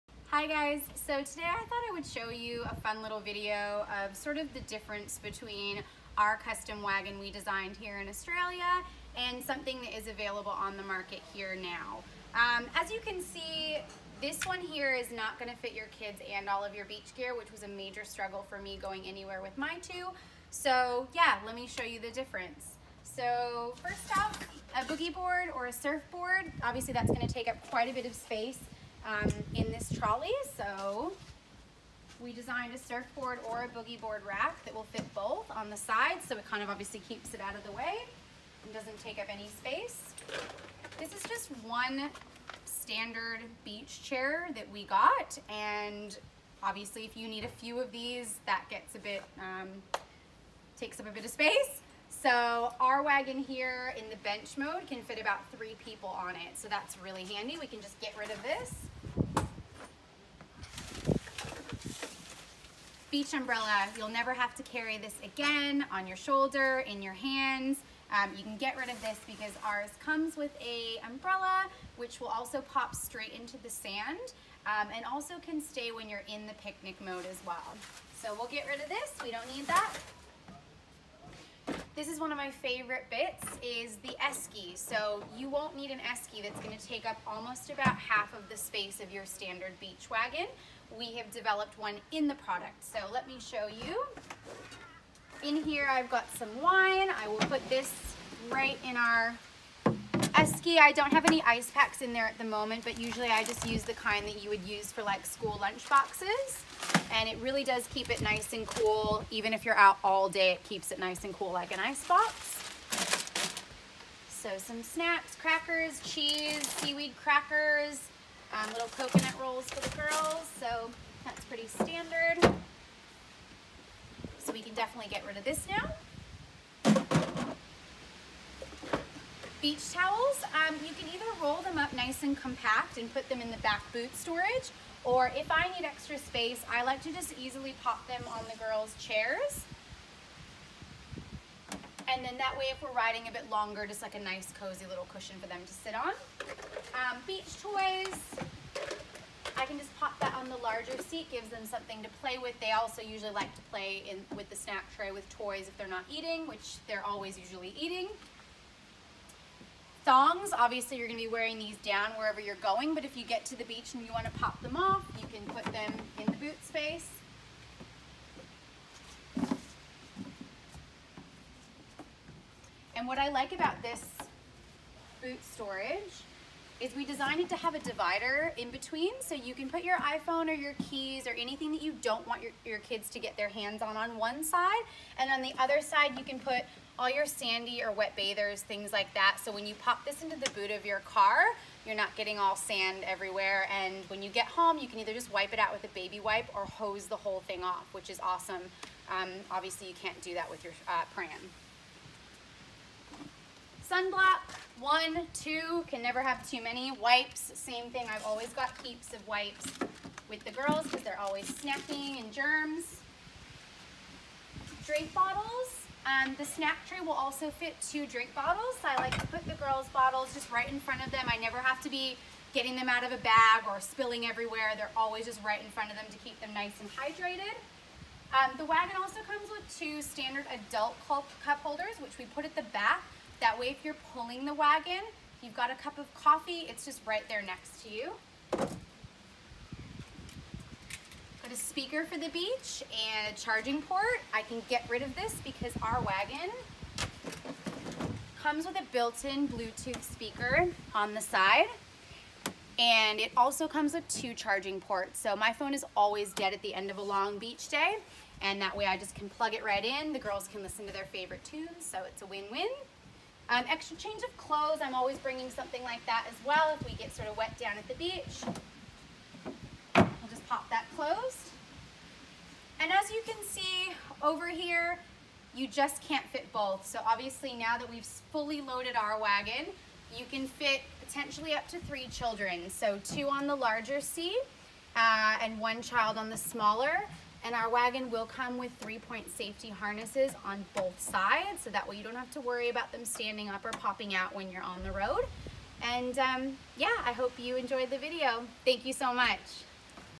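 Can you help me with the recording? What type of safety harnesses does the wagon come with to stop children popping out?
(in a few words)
Three-point.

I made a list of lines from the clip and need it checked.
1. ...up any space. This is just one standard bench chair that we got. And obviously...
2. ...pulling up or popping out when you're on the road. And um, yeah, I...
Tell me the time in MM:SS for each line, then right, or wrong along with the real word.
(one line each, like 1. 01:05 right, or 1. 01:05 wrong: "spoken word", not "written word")
1. 00:39 wrong: "beach", not "bench"
2. 04:53 wrong: "standing", not "pulling".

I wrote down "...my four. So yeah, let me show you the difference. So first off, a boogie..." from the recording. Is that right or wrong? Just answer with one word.
wrong.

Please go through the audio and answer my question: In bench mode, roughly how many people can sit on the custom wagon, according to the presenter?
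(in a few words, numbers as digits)
3.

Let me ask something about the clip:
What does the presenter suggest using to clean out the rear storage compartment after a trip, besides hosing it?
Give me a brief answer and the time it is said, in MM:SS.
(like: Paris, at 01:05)
A baby wipe, at 03:15.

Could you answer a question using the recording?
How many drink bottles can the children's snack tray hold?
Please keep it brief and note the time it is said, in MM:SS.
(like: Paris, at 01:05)
2, at 03:37.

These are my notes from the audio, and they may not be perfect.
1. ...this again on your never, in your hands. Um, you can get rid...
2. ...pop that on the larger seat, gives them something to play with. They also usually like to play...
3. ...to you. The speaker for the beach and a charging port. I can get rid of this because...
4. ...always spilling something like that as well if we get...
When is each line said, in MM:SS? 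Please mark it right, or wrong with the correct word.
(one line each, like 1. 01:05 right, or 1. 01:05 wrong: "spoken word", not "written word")
1. 01:04 wrong: "shoulder", not "never"
2. 02:29 right
3. 03:57 right
4. 04:24 wrong: "bringing", not "spilling".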